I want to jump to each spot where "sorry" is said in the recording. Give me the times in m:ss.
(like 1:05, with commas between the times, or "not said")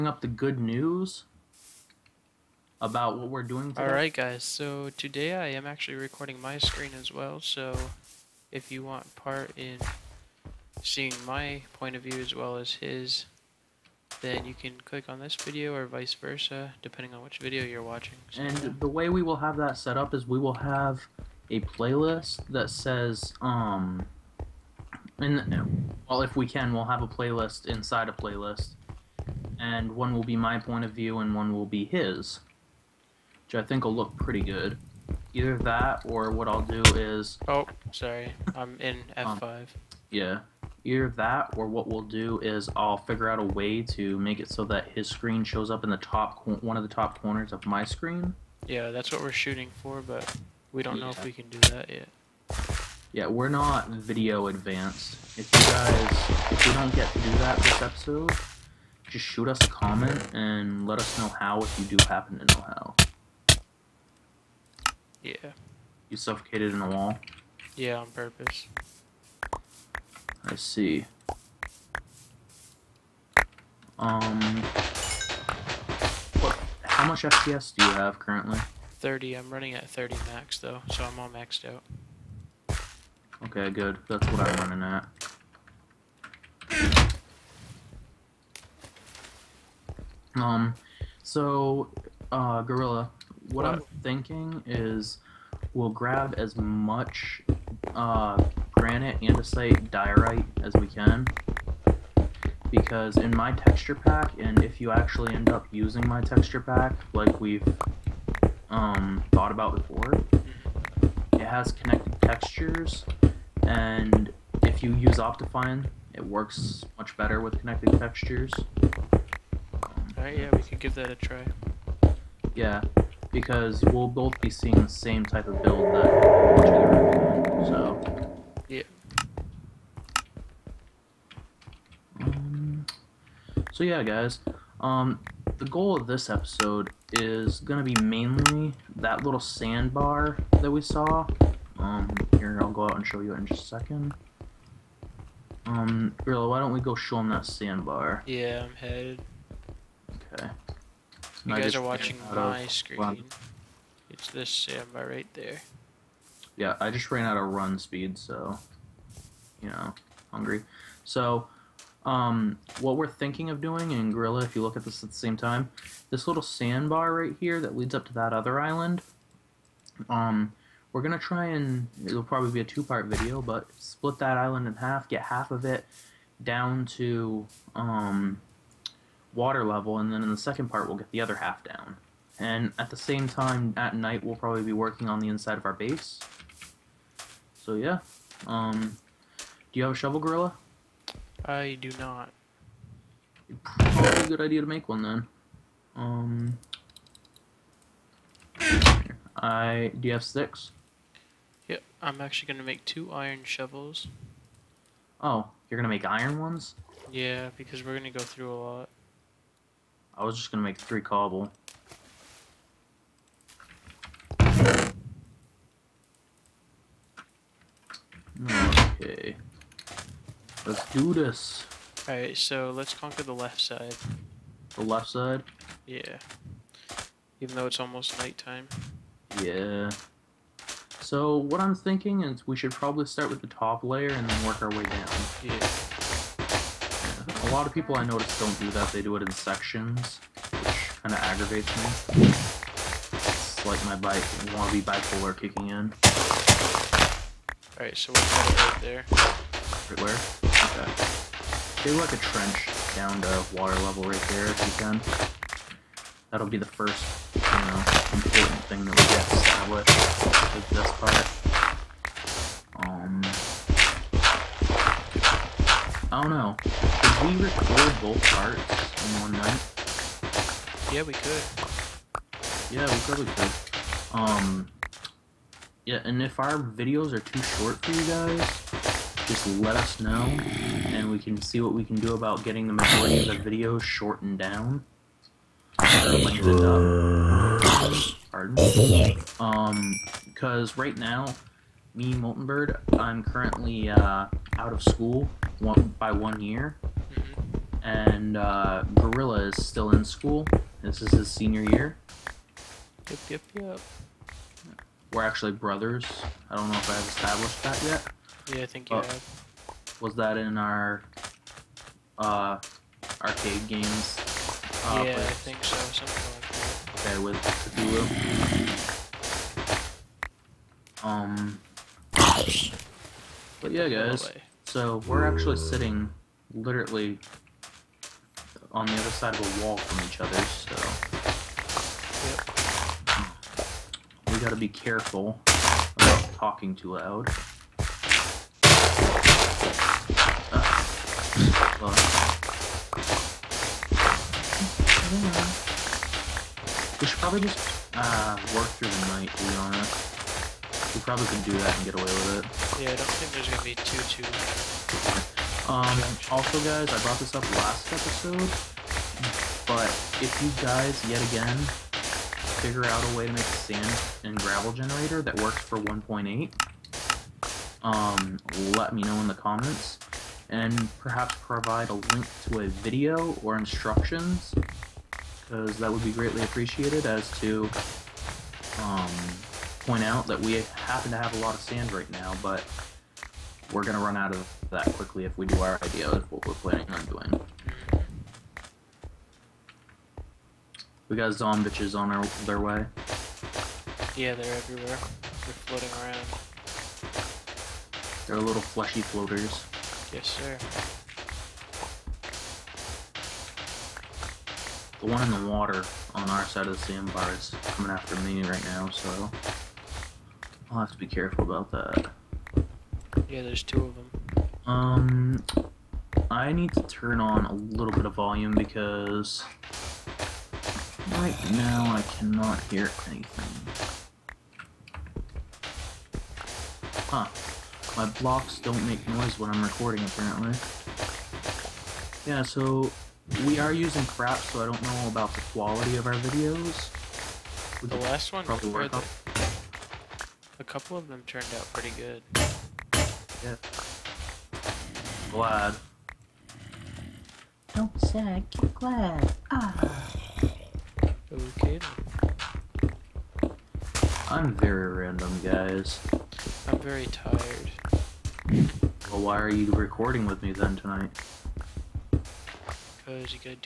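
0:37.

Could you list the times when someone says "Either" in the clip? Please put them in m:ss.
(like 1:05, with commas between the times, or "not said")
0:35, 0:40.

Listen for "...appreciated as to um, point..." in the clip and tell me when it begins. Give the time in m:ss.
6:16.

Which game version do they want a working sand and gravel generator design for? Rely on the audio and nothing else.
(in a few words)
1.8.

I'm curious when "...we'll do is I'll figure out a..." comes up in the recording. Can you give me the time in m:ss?
0:41.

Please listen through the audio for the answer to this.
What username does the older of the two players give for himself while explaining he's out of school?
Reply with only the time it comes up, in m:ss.
4:52.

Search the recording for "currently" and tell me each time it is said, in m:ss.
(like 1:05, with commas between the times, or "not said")
1:18, 4:53.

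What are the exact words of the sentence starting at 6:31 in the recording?
We got zombies on our, their way.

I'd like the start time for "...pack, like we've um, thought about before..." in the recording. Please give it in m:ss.
1:46.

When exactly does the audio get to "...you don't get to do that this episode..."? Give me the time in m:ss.
0:56.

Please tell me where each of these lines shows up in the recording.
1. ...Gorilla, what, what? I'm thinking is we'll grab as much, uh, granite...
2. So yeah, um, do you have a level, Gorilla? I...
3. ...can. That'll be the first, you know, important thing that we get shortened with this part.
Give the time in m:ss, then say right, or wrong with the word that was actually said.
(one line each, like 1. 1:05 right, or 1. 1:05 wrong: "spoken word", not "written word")
1. 1:32 right
2. 3:07 wrong: "shovel", not "level"
3. 4:14 wrong: "established", not "shortened".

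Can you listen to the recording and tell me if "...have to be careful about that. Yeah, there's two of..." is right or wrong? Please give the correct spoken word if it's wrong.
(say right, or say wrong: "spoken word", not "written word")
right.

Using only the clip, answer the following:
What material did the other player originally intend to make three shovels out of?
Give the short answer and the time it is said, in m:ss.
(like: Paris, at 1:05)
Cobble, at 3:30.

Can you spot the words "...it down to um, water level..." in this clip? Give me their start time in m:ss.
2:55.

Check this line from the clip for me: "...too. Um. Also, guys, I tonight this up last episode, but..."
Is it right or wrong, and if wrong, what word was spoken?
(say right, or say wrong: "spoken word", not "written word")
wrong: "brought", not "tonight".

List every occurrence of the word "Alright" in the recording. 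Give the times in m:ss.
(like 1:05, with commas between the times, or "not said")
0:03, 2:00, 3:42, 4:07.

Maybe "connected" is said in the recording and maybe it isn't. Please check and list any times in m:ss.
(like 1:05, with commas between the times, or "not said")
1:51, 1:57.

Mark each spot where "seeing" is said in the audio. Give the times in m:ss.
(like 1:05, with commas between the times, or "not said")
0:10, 2:04.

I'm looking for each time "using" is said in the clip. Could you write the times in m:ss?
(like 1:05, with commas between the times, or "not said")
1:45, 7:13.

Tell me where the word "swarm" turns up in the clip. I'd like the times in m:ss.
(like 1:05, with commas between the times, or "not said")
not said.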